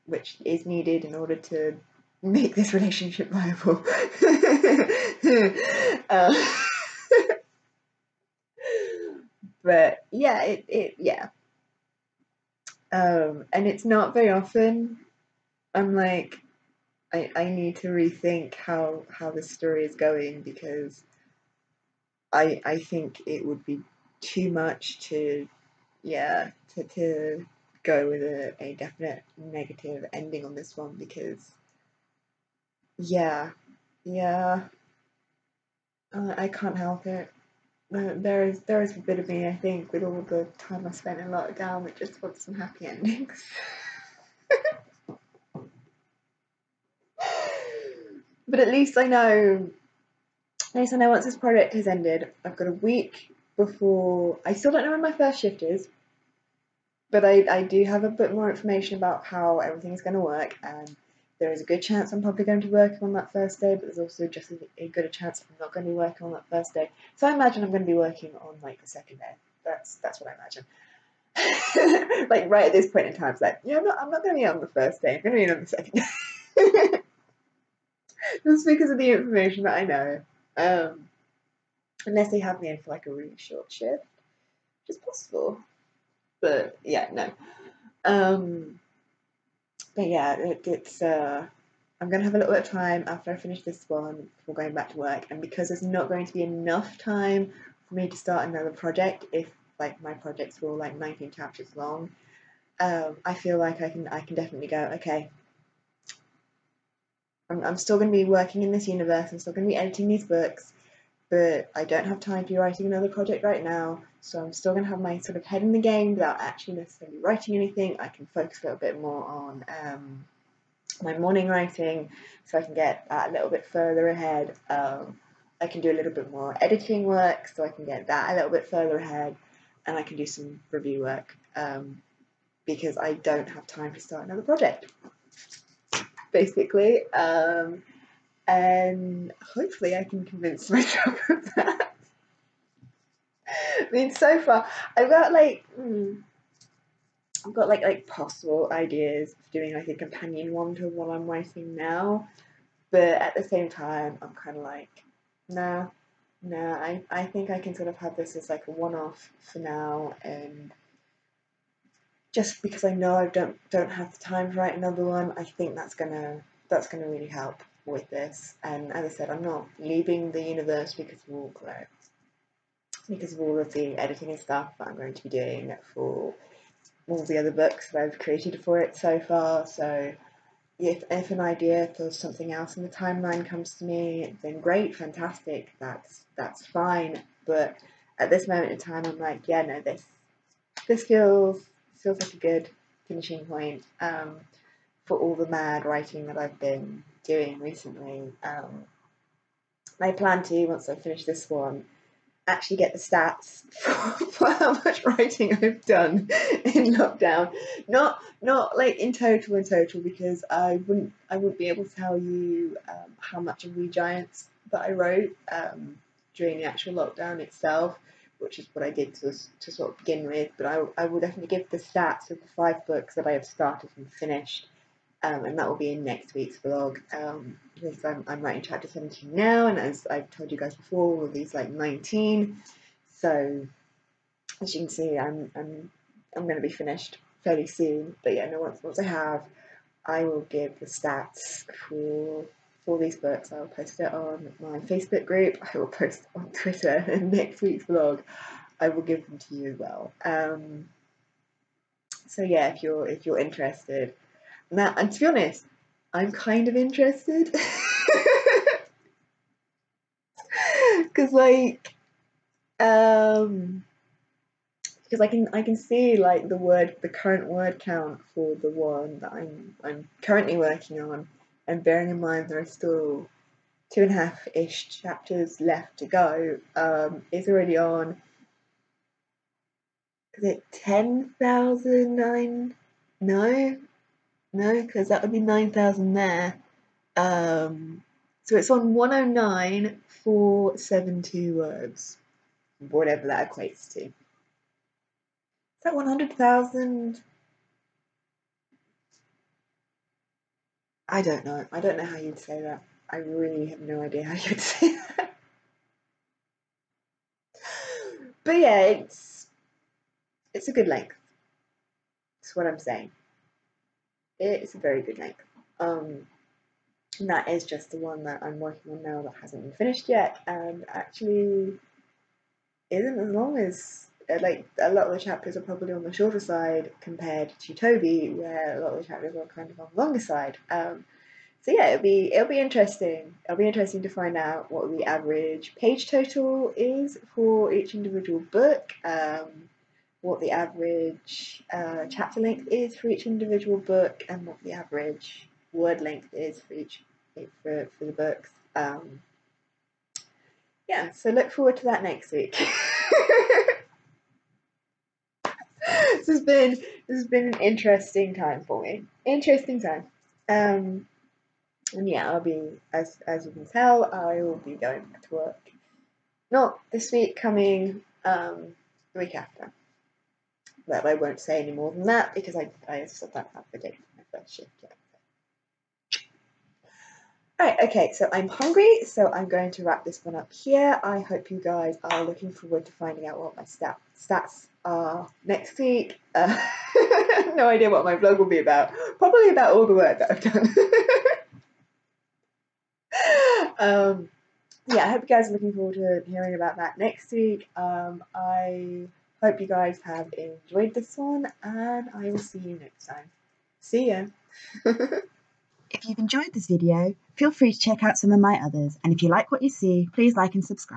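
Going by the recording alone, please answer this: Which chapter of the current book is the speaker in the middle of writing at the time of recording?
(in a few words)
Chapter 17.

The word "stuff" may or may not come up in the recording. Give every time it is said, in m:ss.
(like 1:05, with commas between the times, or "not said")
2:54.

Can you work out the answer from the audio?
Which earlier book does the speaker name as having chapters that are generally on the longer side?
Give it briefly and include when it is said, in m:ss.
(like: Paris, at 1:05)
Toby, at 5:27.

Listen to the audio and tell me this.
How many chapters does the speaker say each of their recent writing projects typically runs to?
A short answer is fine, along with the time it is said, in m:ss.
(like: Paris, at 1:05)
19, at 1:40.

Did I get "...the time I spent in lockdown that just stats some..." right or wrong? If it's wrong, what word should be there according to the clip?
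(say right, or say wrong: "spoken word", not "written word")
wrong: "wants", not "stats".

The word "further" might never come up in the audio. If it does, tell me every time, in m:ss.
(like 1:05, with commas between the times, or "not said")
2:03, 2:08.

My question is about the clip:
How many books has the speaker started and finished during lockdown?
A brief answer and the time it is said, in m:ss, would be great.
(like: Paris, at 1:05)
5, at 3:42.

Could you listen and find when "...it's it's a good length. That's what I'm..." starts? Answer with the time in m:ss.
5:08.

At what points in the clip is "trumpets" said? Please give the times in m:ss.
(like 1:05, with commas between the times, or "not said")
not said.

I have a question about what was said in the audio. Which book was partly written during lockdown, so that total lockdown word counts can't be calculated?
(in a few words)
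We Giants.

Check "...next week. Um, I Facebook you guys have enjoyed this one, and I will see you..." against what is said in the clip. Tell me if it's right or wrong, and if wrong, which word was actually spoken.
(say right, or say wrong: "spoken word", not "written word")
wrong: "Hope", not "Facebook".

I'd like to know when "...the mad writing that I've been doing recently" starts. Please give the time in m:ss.
3:15.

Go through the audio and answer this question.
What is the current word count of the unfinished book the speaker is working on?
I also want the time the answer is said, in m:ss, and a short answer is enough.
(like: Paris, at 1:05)
109,472, at 4:48.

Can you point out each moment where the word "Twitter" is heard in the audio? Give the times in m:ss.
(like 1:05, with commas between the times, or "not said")
4:06.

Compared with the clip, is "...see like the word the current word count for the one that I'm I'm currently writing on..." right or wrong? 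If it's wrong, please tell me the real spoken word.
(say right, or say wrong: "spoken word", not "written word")
wrong: "working", not "writing".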